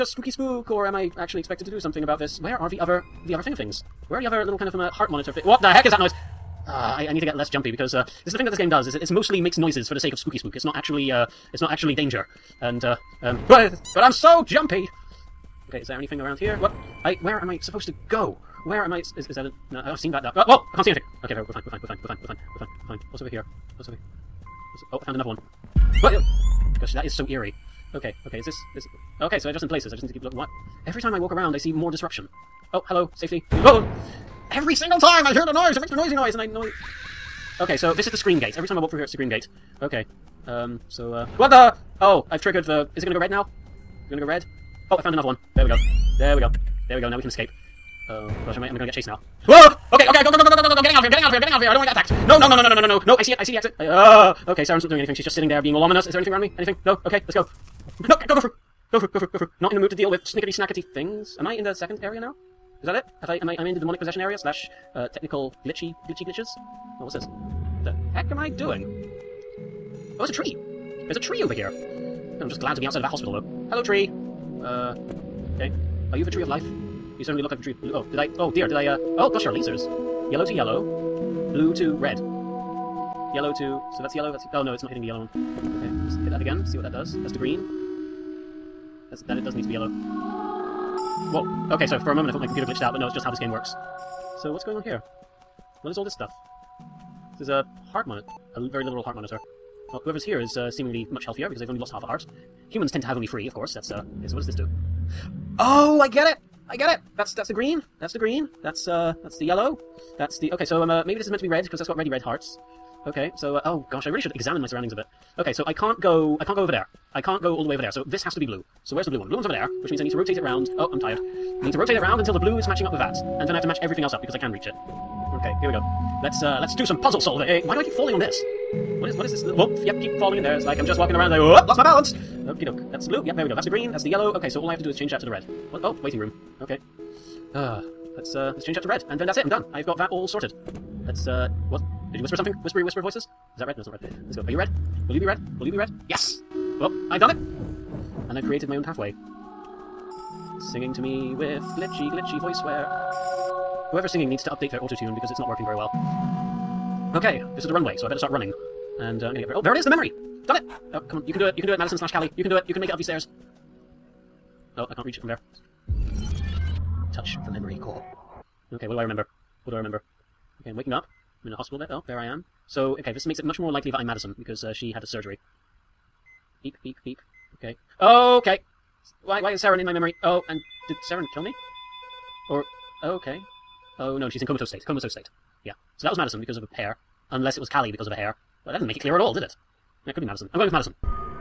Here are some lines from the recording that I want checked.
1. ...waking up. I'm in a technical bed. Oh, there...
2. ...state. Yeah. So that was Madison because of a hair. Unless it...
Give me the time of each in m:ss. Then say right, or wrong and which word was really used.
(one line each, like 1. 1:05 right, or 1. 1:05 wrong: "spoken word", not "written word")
1. 2:50 wrong: "hospital", not "technical"
2. 3:05 right.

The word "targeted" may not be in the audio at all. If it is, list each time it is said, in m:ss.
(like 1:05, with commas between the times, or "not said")
not said.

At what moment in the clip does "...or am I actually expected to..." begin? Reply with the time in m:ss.
0:00.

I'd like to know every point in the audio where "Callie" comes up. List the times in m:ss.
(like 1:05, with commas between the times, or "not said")
2:42, 3:07.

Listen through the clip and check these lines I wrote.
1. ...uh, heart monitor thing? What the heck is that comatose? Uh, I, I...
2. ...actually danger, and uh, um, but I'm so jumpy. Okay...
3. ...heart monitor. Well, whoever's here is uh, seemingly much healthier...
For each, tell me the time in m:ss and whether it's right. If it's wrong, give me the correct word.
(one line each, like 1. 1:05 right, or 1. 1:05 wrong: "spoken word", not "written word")
1. 0:04 wrong: "noise", not "comatose"
2. 0:11 right
3. 1:39 right.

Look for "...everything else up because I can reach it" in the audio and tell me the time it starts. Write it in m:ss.
2:03.